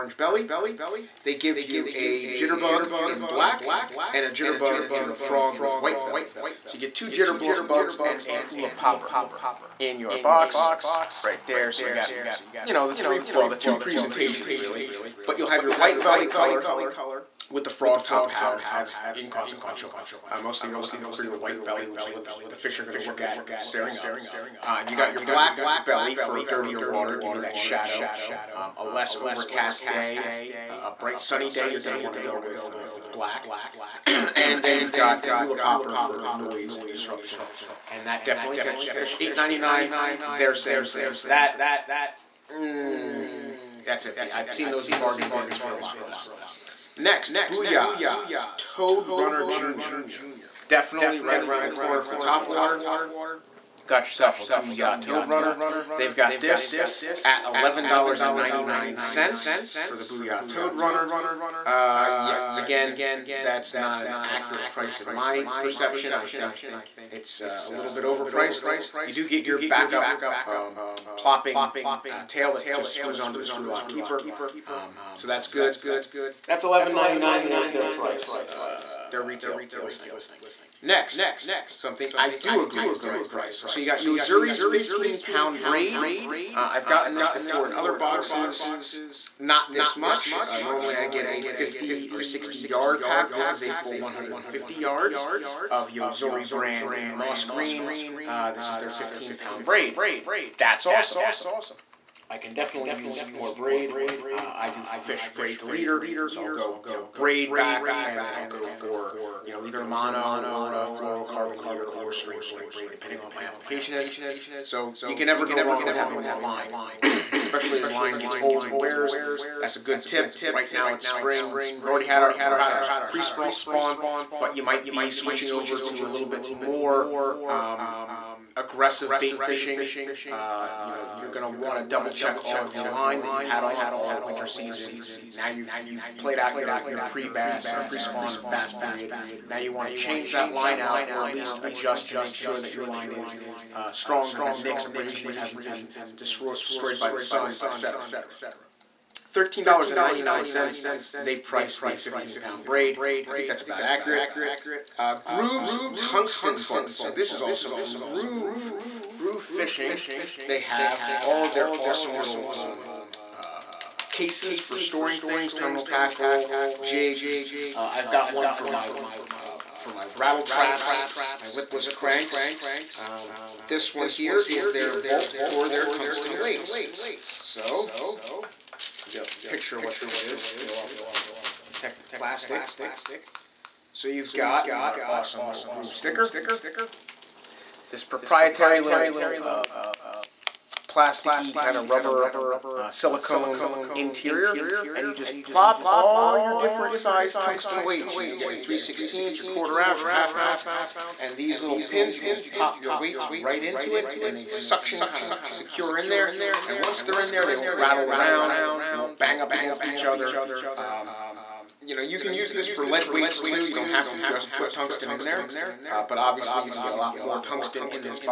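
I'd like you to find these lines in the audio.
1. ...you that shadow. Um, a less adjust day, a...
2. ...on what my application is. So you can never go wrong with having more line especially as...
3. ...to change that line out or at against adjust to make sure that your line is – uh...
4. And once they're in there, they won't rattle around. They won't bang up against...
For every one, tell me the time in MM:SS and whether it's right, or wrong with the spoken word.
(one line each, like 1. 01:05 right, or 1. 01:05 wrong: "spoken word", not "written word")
1. 00:27 wrong: "overcast", not "adjust"
2. 01:53 right
3. 02:19 wrong: "least", not "against"
4. 03:26 right.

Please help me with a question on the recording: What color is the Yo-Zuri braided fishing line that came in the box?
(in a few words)
moss green.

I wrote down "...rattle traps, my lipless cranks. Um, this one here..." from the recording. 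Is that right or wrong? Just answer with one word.
right.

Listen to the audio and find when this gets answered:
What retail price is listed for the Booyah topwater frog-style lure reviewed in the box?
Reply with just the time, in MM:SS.
00:57.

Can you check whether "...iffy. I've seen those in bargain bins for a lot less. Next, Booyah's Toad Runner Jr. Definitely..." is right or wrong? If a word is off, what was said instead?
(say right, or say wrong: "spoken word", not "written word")
right.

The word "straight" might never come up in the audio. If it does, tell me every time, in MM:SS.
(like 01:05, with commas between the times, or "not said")
01:52.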